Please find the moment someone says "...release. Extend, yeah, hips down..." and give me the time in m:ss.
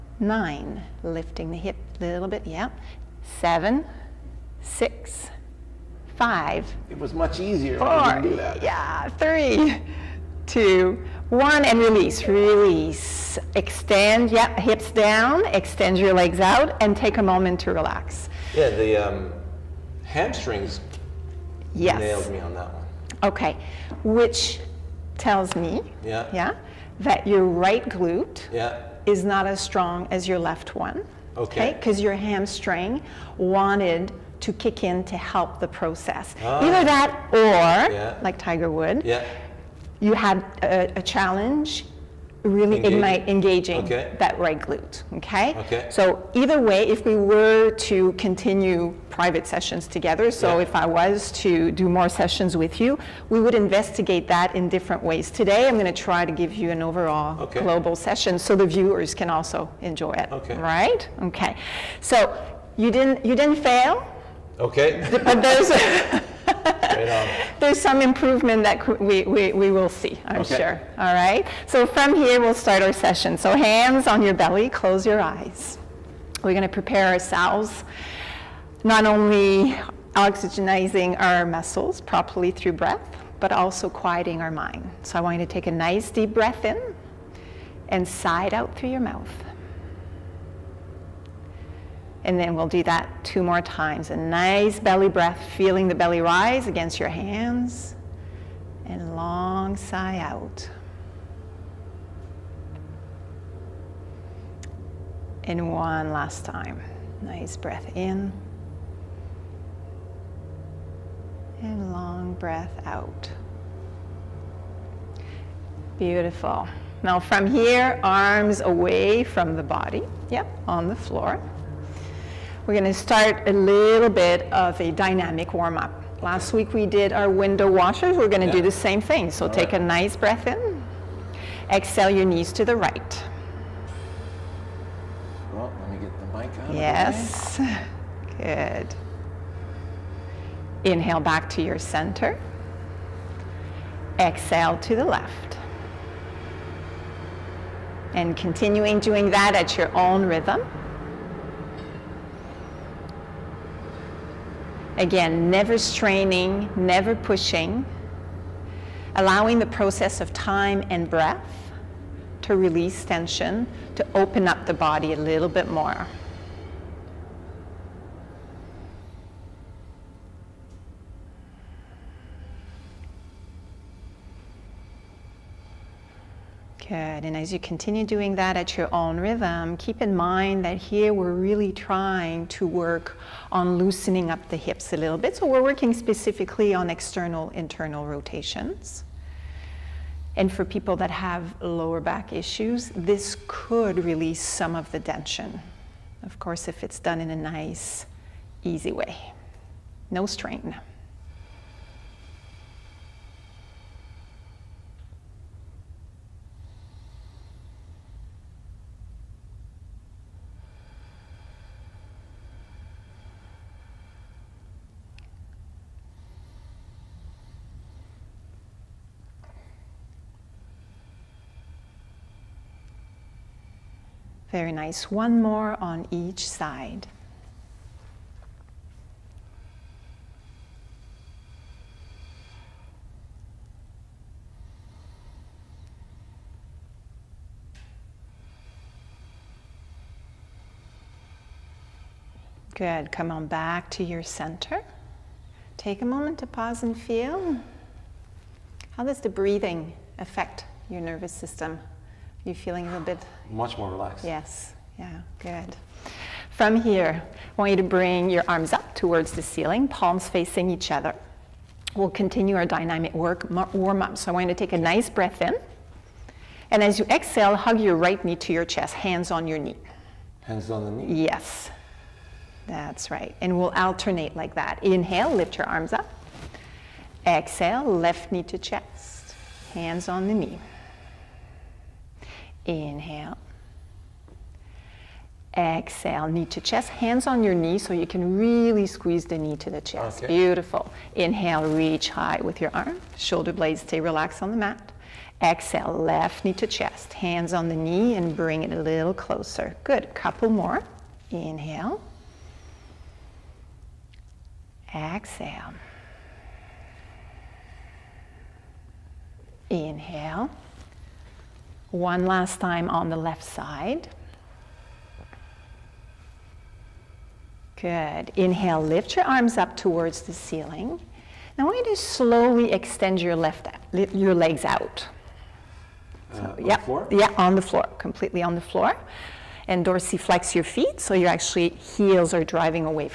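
0:12.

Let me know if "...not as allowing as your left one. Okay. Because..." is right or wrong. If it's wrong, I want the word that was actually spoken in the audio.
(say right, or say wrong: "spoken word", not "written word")
wrong: "strong", not "allowing".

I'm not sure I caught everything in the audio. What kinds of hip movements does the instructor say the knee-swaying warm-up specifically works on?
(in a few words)
external, internal rotations.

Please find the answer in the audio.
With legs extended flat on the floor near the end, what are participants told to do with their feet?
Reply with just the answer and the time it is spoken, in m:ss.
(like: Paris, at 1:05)
dorsiflex, at 5:29.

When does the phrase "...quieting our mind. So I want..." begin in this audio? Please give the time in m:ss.
1:23.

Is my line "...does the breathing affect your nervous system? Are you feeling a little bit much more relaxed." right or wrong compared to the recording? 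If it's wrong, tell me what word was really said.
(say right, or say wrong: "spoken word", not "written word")
right.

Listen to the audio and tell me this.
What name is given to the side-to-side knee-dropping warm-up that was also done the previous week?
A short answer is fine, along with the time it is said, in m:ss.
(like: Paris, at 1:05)
window washers, at 2:07.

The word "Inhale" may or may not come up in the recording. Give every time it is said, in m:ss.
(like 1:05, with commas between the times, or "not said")
2:20, 4:34, 4:42, 4:51, 5:01, 5:09, 5:18.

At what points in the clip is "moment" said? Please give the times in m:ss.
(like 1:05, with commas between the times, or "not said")
0:17, 4:06.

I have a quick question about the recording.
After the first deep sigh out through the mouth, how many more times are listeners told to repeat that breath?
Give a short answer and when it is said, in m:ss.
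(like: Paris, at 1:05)
2, at 1:33.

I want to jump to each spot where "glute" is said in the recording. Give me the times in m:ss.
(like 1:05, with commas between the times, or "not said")
0:27, 0:44.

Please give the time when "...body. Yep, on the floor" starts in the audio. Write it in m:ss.
1:59.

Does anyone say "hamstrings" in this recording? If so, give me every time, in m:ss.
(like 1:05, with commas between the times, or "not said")
0:20, 0:32.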